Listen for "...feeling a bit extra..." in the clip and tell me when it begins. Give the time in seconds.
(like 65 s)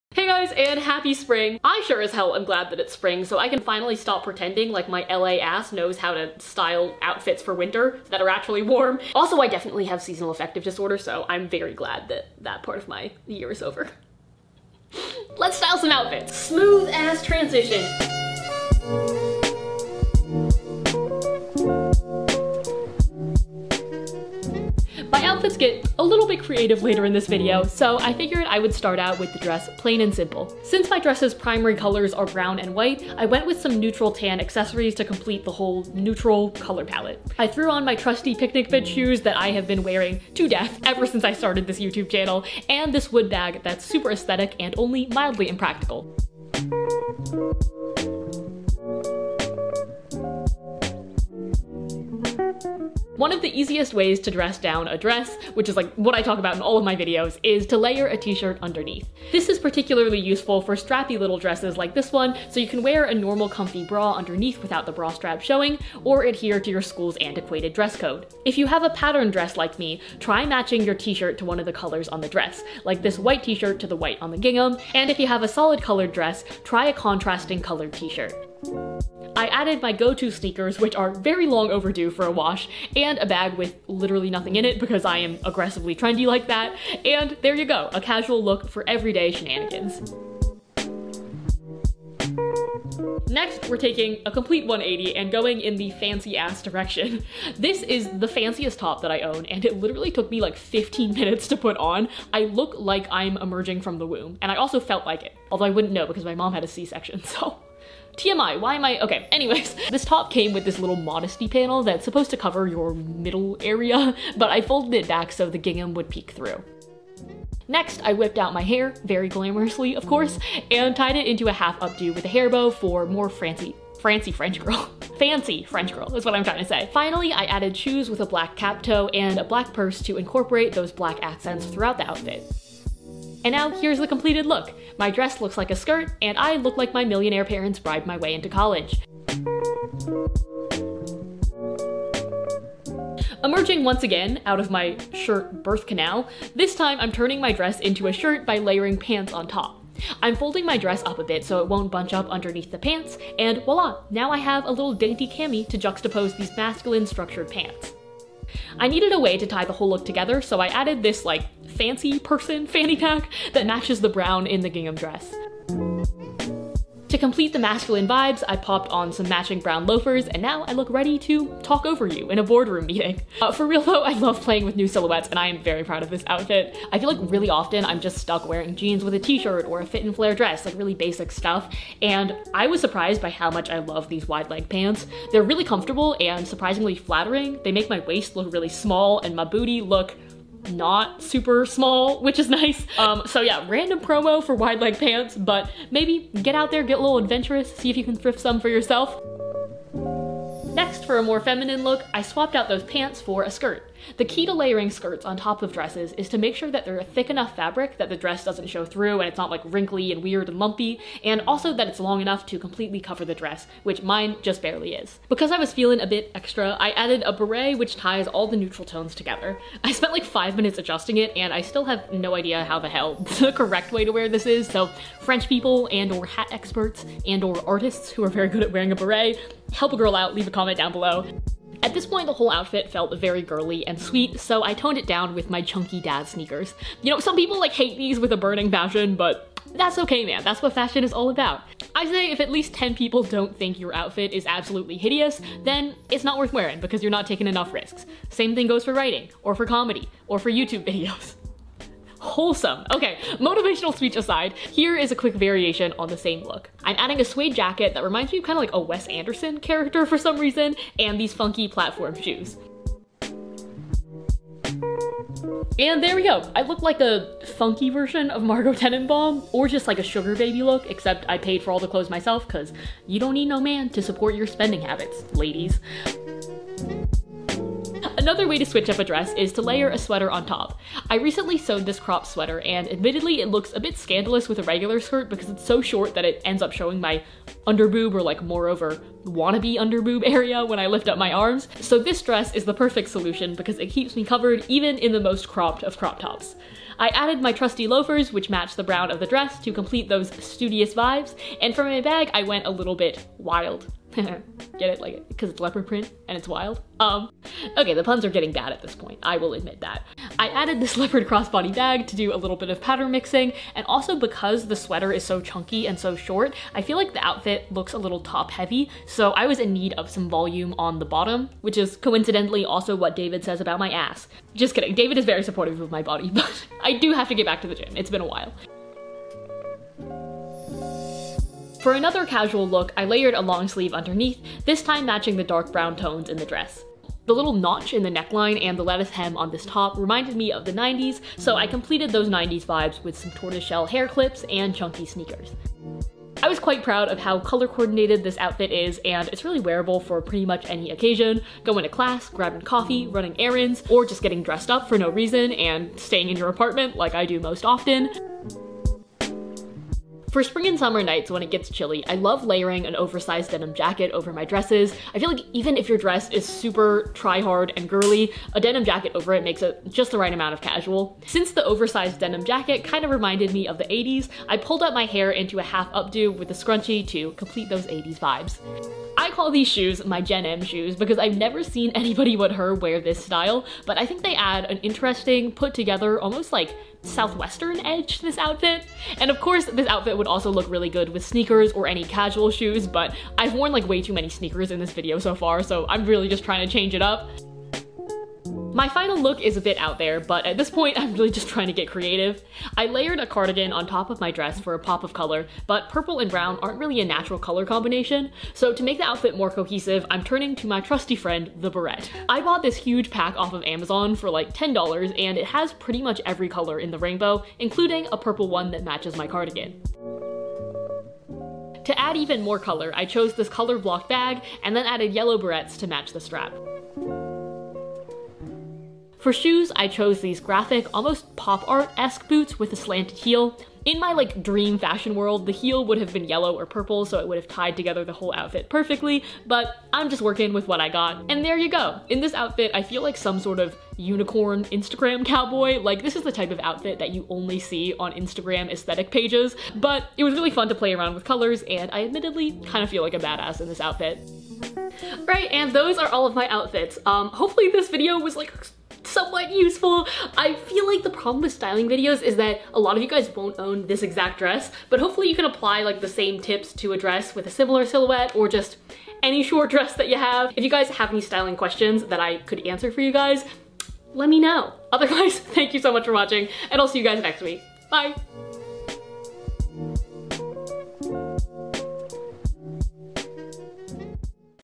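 215 s.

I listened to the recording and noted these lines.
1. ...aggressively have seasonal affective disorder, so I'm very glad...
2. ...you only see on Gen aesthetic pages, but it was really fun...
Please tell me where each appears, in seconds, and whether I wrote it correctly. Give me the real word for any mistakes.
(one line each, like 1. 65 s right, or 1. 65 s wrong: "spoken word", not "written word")
1. 9 s wrong: "definitely", not "aggressively"
2. 447 s wrong: "Instagram", not "Gen".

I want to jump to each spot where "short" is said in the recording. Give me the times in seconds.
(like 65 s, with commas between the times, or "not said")
285 s, 316 s, 469 s.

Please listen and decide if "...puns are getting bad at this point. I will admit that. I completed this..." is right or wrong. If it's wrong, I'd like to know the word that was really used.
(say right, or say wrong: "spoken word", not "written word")
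wrong: "added", not "completed".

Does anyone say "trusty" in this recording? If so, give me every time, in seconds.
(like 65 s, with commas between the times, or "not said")
37 s, 297 s, 410 s.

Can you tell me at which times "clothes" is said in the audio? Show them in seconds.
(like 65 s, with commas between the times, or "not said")
271 s.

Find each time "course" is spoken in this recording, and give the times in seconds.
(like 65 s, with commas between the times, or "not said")
120 s, 389 s.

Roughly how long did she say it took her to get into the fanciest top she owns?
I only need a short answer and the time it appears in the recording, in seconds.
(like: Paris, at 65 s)
15 minutes, at 100 s.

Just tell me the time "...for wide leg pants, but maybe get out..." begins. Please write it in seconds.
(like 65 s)
194 s.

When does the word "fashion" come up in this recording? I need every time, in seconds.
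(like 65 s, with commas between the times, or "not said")
240 s, 434 s.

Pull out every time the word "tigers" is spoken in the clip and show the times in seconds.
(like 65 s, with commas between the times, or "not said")
not said.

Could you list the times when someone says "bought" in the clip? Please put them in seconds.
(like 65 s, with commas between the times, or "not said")
412 s.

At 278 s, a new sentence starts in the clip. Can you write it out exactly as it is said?
Another way to switch up a dress is to layer a sweater on top.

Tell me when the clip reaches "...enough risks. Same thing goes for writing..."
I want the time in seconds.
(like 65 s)
247 s.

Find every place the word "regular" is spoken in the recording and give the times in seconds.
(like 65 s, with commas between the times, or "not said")
284 s.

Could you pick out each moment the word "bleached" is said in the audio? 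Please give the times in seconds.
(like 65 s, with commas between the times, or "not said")
not said.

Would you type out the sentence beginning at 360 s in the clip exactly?
For spring and summer nights when it gets chilly, I love layering an oversized denim jacket over my dresses.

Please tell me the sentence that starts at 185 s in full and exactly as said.
They're really comfortable and surprisingly flattering.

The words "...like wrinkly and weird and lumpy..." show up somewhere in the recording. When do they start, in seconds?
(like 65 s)
209 s.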